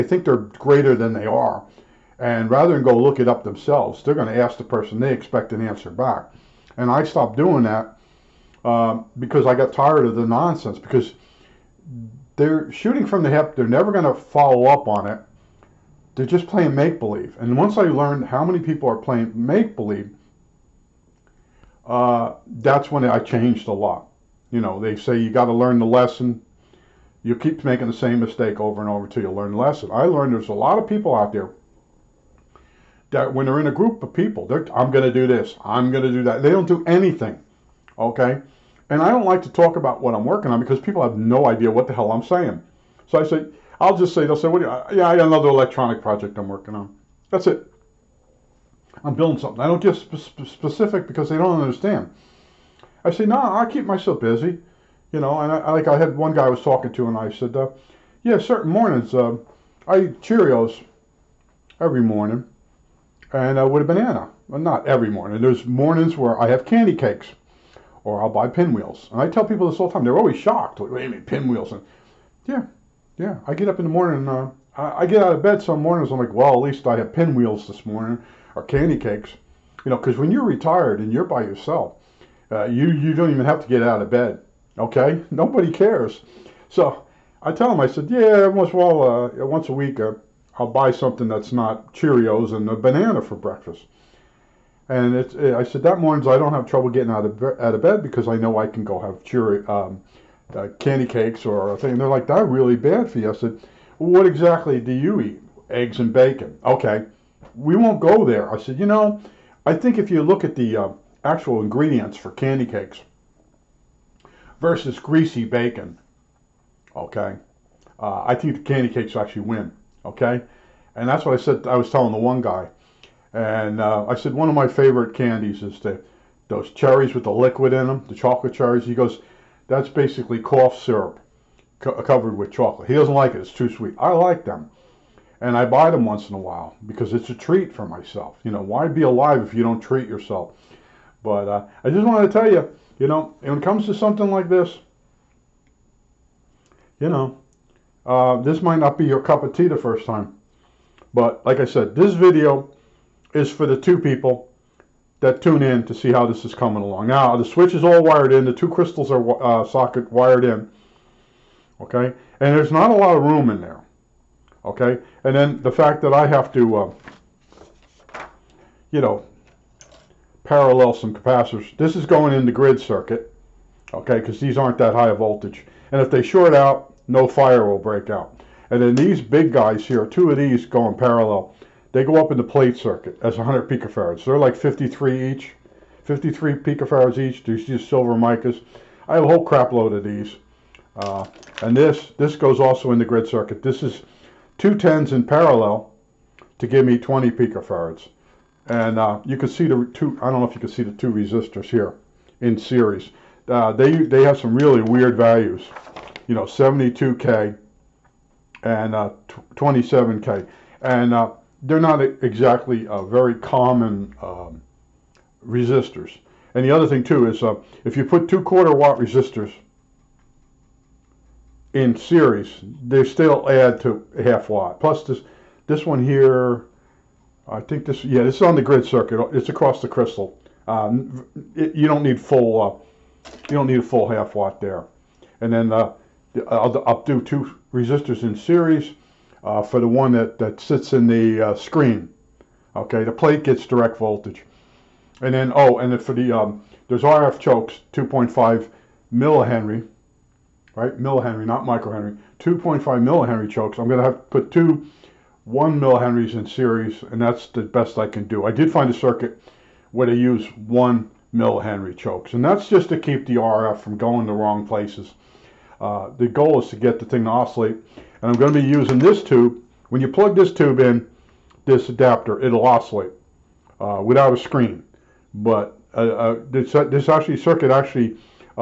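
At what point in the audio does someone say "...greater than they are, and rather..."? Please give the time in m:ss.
0:00.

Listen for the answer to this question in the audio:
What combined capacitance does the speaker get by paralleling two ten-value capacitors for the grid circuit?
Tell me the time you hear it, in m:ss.
3:16.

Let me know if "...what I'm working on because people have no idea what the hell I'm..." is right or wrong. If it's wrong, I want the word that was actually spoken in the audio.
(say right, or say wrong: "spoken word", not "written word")
right.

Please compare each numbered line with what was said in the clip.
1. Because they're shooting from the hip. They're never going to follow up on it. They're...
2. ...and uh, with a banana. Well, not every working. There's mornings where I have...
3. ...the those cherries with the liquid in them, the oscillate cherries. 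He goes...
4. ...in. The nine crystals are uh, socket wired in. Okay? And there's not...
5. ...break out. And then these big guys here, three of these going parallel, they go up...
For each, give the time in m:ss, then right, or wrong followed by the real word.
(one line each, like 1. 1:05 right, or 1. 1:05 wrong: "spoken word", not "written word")
1. 0:10 right
2. 1:03 wrong: "morning", not "working"
3. 2:05 wrong: "chocolate", not "oscillate"
4. 2:38 wrong: "two", not "nine"
5. 2:57 wrong: "two", not "three".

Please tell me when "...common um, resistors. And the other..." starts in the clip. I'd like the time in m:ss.
3:33.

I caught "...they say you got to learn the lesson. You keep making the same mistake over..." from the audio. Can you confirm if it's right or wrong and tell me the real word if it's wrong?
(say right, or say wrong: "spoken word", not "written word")
right.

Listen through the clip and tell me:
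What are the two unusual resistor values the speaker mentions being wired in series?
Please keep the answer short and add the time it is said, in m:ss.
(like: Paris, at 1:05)
72K and 27K, at 3:26.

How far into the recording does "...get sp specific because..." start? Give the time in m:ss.
0:49.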